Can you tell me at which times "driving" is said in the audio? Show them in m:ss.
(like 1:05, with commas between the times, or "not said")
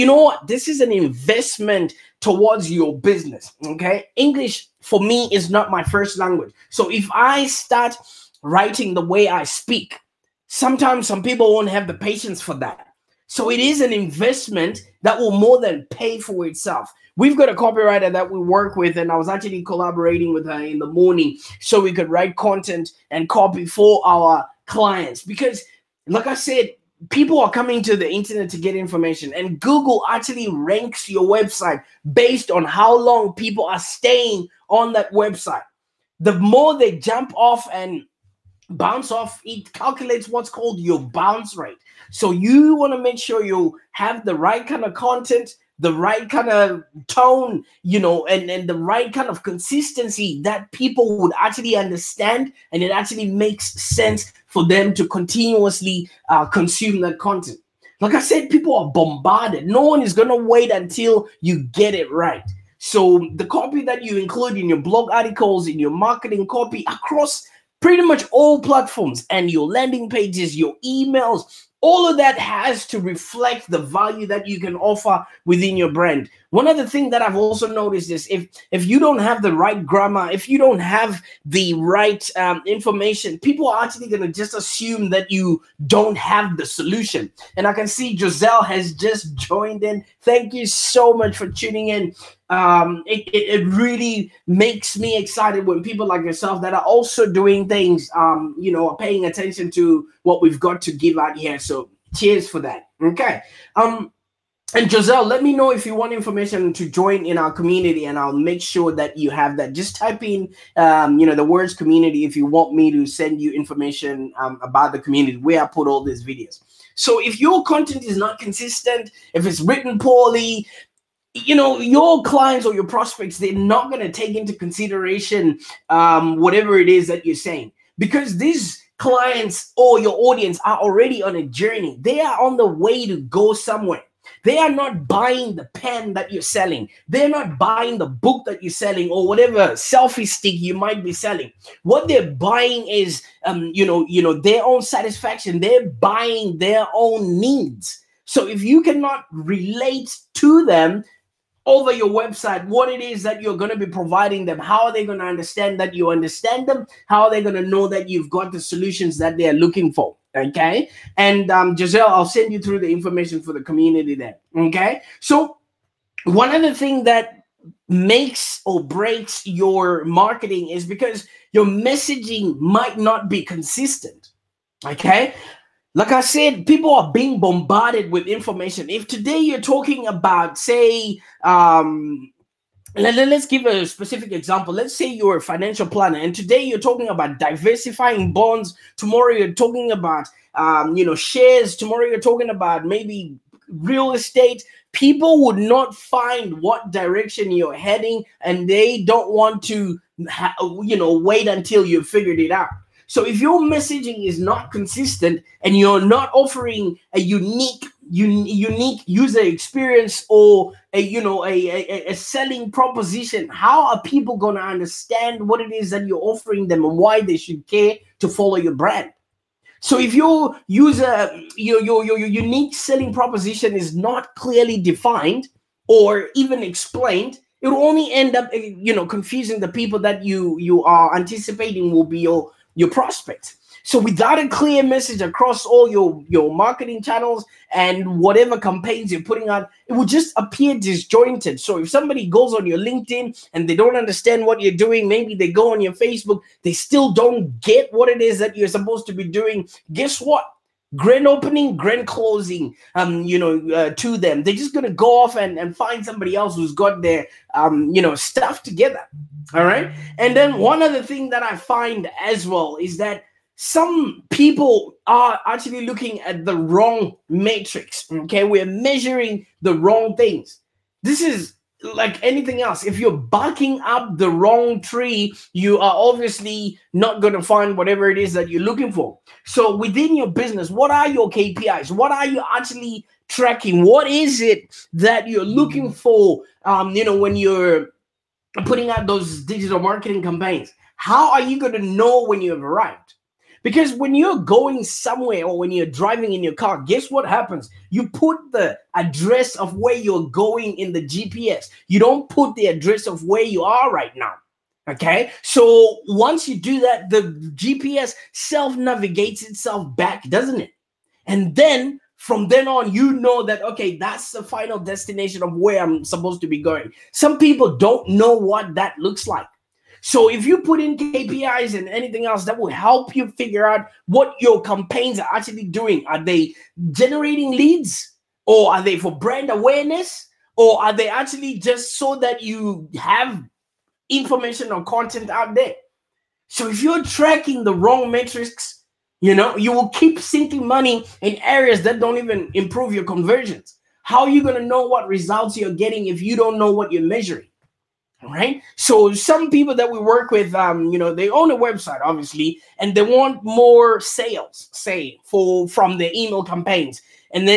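4:55.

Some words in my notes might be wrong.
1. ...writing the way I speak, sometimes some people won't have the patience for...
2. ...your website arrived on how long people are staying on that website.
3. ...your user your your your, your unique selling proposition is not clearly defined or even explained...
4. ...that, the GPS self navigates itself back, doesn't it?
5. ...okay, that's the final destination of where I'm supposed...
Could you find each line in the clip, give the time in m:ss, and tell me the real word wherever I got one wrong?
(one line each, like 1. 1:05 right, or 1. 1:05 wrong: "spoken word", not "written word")
1. 0:08 right
2. 0:31 wrong: "based", not "arrived"
3. 3:40 right
4. 5:06 right
5. 5:13 right.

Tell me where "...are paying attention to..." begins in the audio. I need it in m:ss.
1:38.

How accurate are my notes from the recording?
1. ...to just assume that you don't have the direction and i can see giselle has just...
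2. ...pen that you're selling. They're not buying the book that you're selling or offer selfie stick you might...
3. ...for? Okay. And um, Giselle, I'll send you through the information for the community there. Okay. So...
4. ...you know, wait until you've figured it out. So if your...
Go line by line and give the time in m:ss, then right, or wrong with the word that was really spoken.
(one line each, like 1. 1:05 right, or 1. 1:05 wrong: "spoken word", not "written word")
1. 1:24 wrong: "solution", not "direction"
2. 2:15 wrong: "whatever", not "offer"
3. 2:39 right
4. 3:20 right.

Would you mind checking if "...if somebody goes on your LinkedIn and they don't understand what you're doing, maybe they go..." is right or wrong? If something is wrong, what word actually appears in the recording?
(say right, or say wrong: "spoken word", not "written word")
right.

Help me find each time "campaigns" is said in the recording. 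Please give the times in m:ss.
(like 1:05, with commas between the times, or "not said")
3:58, 4:50, 5:24, 5:56.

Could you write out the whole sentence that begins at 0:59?
No one is going to wait until you get it right.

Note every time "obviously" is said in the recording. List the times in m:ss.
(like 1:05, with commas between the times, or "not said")
4:35, 5:52.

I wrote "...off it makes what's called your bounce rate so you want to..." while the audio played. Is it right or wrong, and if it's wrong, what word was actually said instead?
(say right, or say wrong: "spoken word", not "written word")
wrong: "calculates", not "makes".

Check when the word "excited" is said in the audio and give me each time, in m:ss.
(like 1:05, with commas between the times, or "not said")
1:35.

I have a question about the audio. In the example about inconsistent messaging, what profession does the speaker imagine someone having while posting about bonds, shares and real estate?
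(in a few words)
financial planner.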